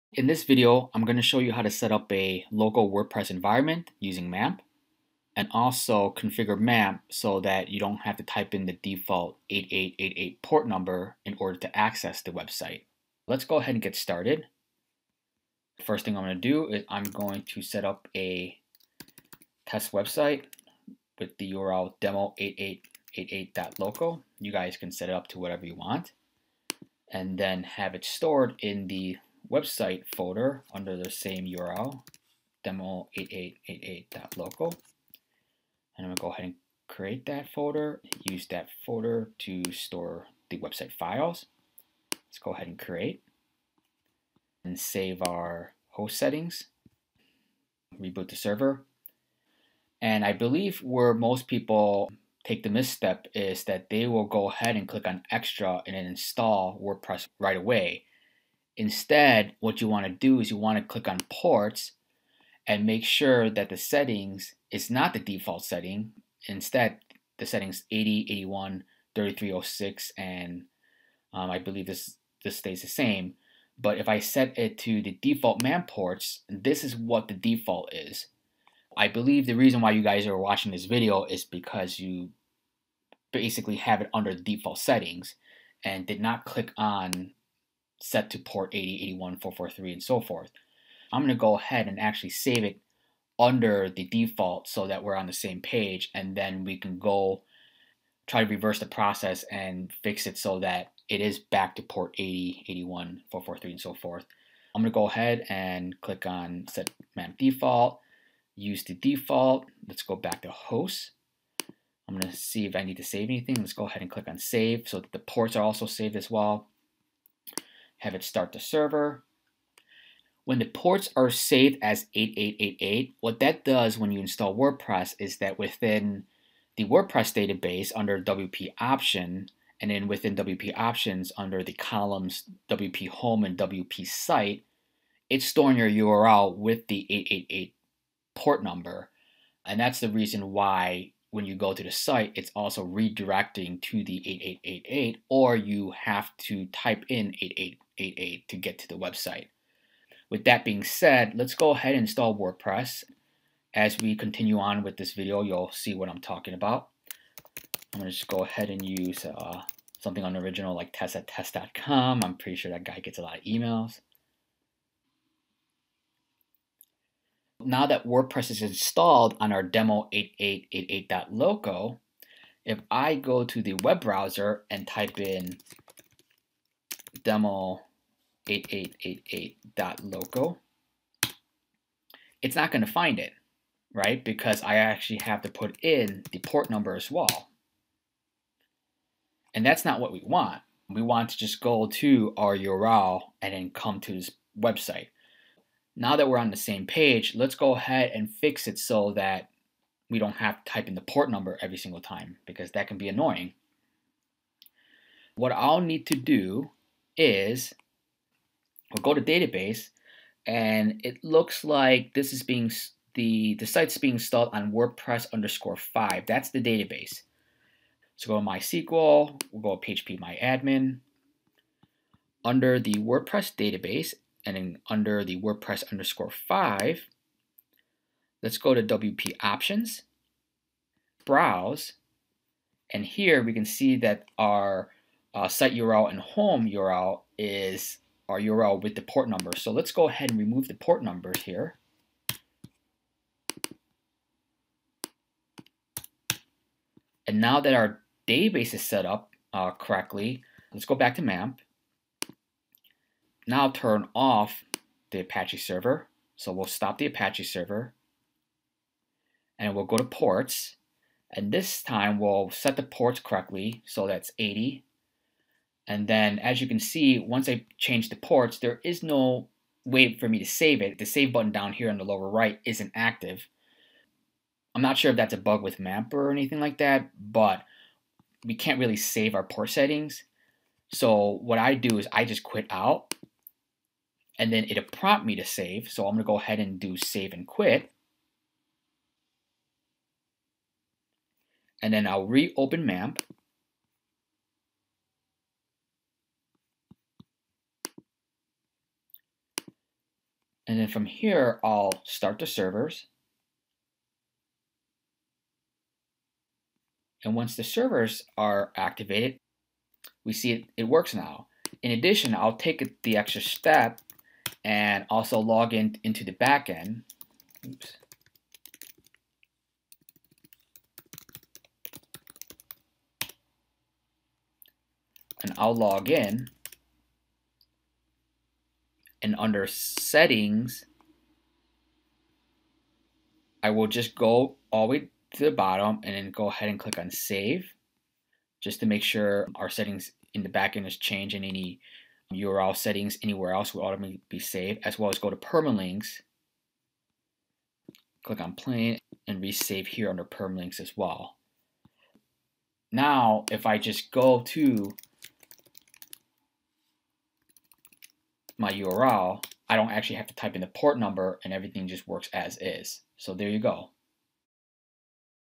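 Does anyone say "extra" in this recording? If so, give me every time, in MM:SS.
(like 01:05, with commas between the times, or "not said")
00:55, 05:13.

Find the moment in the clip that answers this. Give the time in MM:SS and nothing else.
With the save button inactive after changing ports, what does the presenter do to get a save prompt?
04:42.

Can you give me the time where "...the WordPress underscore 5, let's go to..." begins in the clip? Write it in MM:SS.
03:45.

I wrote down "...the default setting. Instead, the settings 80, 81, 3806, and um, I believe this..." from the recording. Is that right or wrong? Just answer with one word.
wrong.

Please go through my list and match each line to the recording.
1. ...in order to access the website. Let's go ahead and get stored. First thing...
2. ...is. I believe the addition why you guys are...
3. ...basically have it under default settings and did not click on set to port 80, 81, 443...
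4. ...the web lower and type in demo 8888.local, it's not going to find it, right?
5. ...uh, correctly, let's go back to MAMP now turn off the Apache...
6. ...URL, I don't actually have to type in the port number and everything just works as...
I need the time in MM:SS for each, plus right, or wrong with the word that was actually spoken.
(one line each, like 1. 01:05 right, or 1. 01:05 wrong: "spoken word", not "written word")
1. 00:11 wrong: "started", not "stored"
2. 01:17 wrong: "reason", not "addition"
3. 01:23 right
4. 02:53 wrong: "browser", not "lower"
5. 04:09 right
6. 05:58 right.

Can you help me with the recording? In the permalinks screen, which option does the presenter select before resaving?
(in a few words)
plain.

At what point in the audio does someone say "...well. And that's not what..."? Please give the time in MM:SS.
03:07.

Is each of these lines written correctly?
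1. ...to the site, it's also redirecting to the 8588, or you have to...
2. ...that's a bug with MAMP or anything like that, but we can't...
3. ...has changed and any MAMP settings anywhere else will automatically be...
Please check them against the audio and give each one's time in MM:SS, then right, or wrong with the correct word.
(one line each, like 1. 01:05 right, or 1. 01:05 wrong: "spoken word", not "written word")
1. 02:21 wrong: "8888", not "8588"
2. 04:35 right
3. 05:40 wrong: "URL", not "MAMP".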